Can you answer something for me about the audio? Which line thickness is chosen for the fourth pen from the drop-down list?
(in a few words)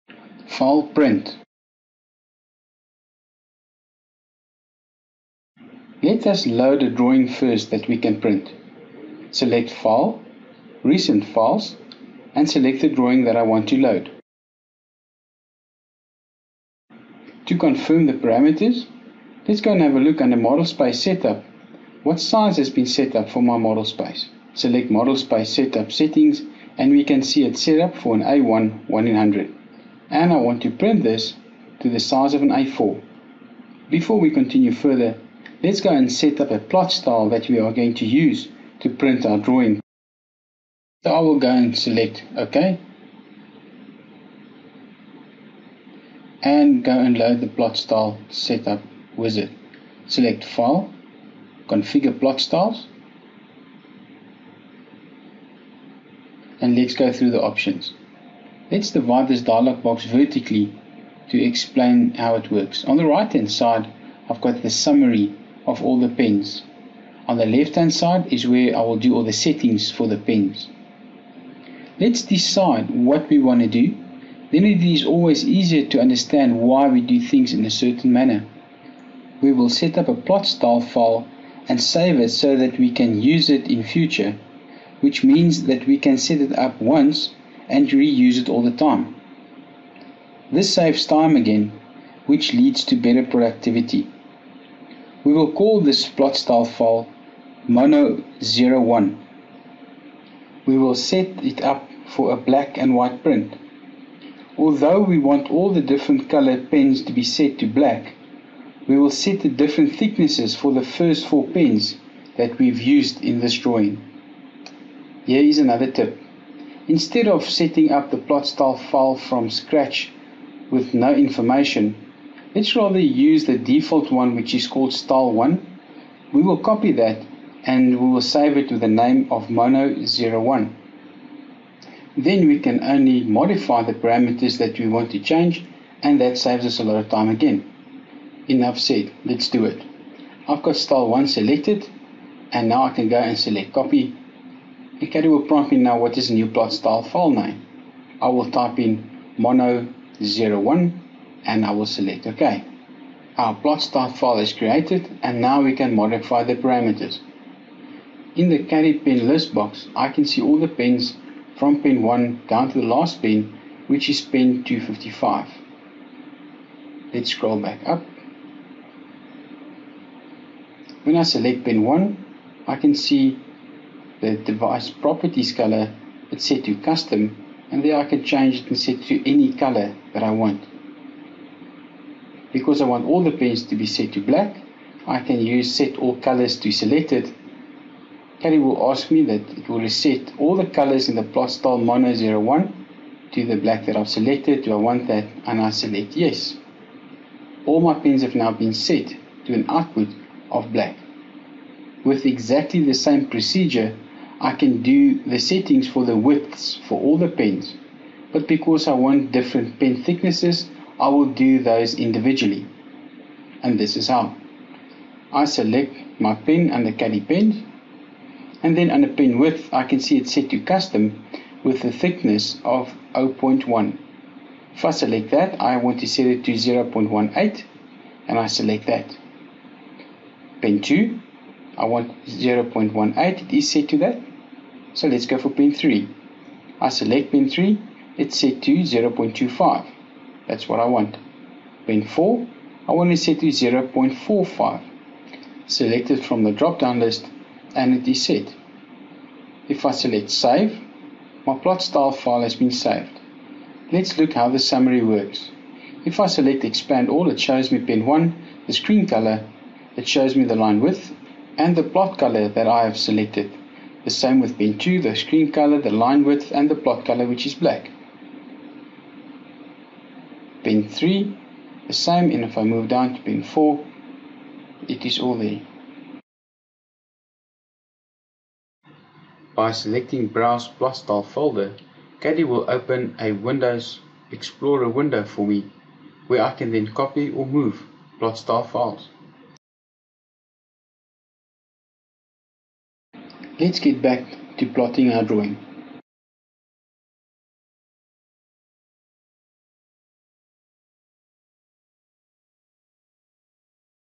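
0.45.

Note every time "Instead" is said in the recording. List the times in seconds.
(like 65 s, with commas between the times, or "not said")
116 s.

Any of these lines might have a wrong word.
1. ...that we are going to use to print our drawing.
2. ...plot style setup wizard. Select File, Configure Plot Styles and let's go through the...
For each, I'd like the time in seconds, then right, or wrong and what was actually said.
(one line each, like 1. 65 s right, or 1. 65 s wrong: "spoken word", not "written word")
1. 37 s right
2. 47 s right.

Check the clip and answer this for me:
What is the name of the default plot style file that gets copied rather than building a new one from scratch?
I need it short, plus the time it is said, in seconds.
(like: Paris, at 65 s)
style1, at 124 s.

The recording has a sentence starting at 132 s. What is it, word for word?
Then we can only modify the parameters that we want to change and that saves us a lot of time again.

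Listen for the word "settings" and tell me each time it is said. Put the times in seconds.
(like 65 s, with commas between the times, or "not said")
25 s, 69 s, 117 s, 205 s.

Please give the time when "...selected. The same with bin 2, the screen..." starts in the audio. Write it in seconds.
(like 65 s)
262 s.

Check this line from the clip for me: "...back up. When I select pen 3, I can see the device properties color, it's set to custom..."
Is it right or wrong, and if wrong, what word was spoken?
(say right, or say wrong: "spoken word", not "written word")
wrong: "1", not "3".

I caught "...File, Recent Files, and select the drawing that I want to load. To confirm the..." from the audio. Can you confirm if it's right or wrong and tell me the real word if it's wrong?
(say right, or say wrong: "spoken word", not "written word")
right.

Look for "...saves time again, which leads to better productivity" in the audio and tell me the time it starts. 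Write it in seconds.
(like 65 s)
90 s.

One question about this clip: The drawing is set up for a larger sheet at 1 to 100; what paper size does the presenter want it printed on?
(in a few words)
A4.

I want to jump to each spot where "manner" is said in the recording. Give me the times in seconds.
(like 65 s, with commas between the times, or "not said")
78 s.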